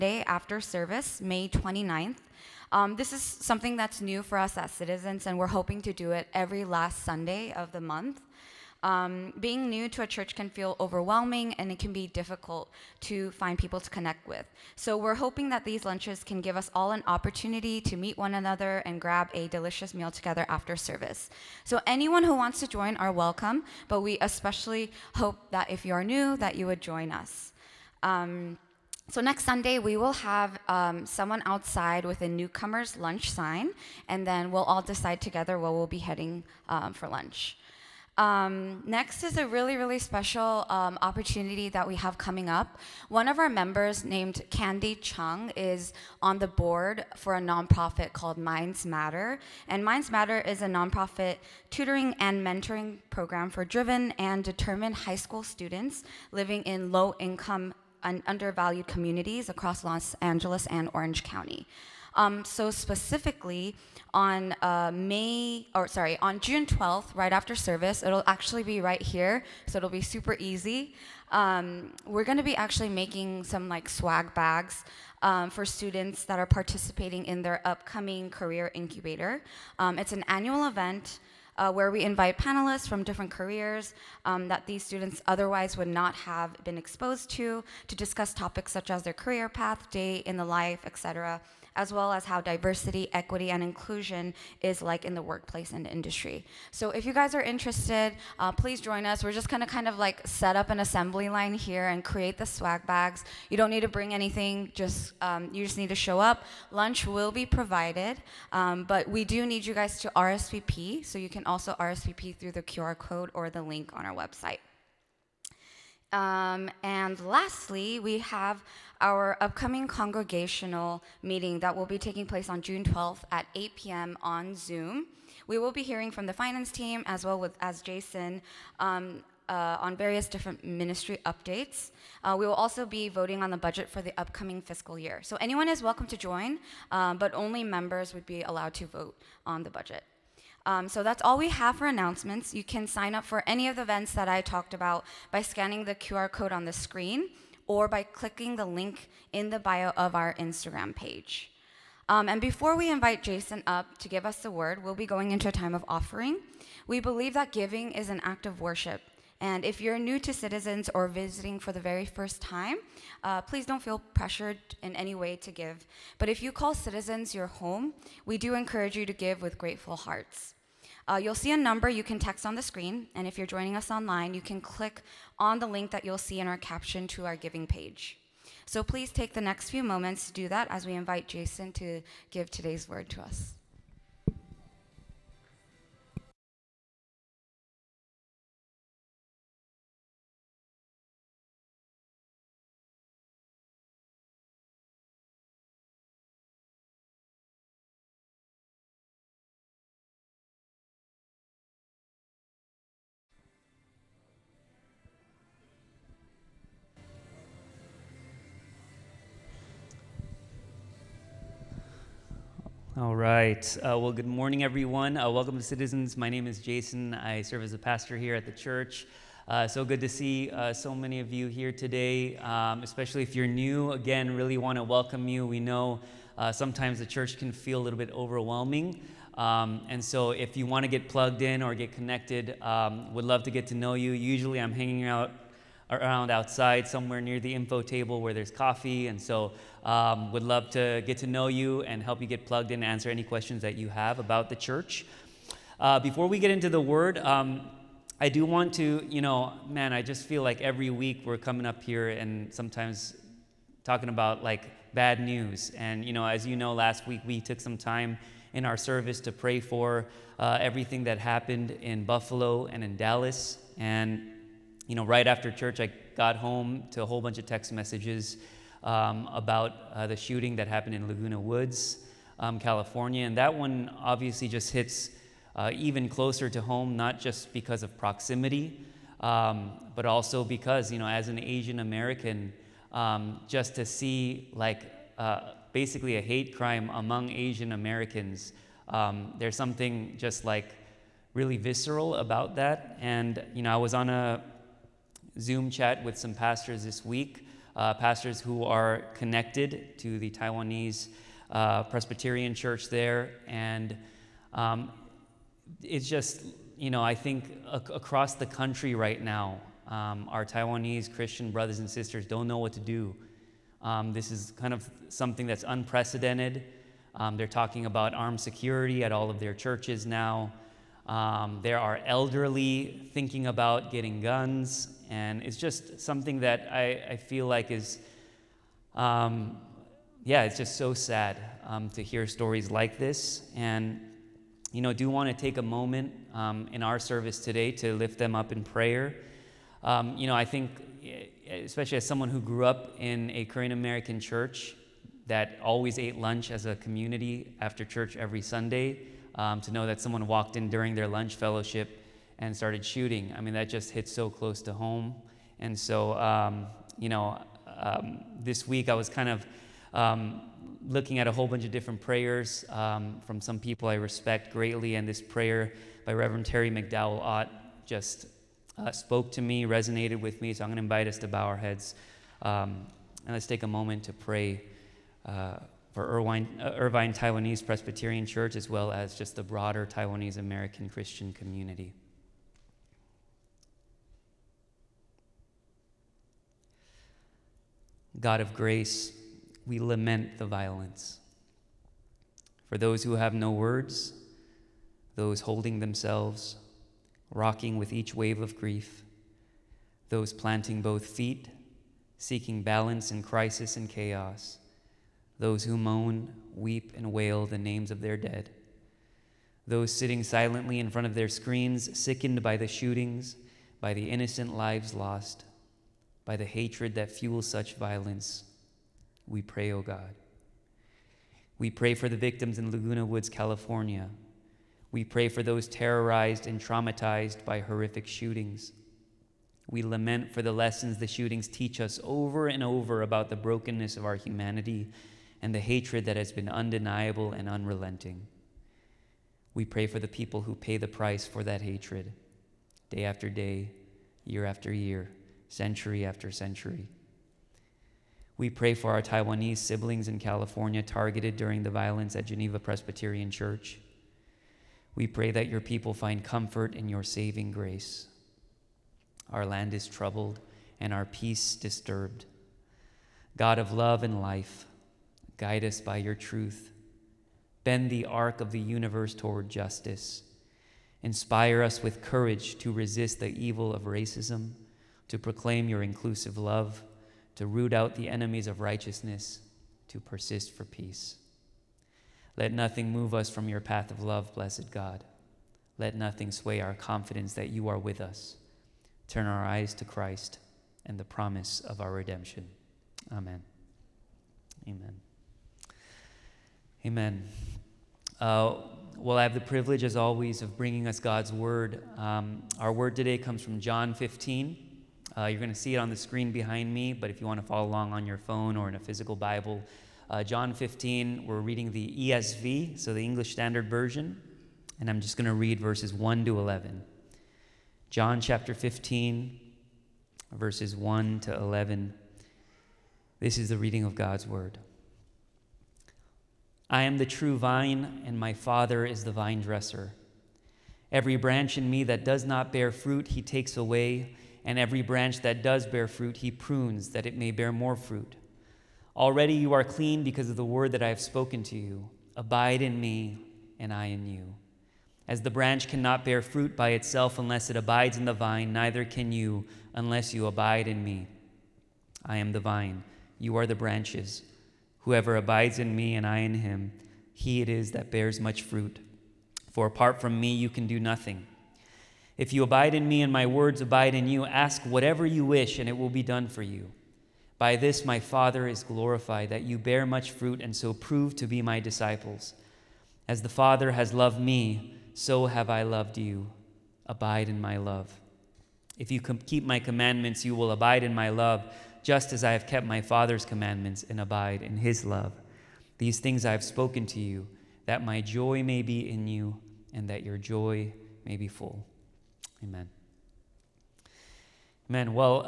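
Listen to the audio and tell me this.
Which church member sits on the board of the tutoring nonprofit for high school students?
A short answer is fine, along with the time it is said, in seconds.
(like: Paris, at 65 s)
Candy Chung, at 44 s.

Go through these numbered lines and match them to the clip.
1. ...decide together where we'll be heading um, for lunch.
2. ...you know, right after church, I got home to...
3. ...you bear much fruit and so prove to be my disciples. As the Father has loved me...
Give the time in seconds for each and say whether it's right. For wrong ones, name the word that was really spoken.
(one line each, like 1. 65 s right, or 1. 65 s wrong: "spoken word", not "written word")
1. 34 s right
2. 264 s right
3. 569 s right.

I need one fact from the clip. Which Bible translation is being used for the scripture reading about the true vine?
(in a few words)
English Standard Version.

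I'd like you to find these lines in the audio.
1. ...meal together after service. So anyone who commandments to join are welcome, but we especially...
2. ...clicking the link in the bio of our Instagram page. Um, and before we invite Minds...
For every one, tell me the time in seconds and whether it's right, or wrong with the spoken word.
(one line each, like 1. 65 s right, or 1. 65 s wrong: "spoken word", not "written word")
1. 19 s wrong: "wants", not "commandments"
2. 148 s wrong: "Jason", not "Minds".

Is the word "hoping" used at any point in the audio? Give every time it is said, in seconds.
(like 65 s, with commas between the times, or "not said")
5 s, 15 s.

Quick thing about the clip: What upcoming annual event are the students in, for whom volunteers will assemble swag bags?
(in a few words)
career incubator.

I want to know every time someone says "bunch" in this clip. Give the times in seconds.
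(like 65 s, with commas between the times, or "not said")
267 s, 361 s.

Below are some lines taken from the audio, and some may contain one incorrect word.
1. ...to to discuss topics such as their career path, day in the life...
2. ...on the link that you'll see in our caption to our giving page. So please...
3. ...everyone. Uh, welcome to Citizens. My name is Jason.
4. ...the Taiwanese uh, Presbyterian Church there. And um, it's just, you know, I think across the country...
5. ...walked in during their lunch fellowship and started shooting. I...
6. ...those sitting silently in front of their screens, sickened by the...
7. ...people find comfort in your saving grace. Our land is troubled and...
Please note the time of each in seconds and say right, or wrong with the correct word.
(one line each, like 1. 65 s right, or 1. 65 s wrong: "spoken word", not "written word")
1. 87 s right
2. 175 s right
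3. 214 s right
4. 300 s right
5. 350 s right
6. 409 s right
7. 455 s right.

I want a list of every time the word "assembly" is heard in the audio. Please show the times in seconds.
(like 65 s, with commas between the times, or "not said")
100 s.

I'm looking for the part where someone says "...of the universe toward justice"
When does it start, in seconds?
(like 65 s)
468 s.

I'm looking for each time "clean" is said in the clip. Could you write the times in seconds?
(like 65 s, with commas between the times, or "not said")
539 s.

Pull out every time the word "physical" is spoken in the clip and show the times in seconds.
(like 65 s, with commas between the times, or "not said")
508 s.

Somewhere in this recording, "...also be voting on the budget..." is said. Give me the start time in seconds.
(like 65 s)
132 s.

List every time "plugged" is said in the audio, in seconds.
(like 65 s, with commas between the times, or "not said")
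231 s, 242 s.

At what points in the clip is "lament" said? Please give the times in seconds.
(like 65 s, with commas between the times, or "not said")
389 s, 429 s.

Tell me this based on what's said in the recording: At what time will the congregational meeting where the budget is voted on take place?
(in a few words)
8 p.m.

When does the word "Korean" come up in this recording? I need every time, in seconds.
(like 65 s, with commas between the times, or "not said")
343 s.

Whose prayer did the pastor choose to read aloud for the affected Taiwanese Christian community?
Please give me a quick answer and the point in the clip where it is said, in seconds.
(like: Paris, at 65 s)
Terri McDowell Ott, at 366 s.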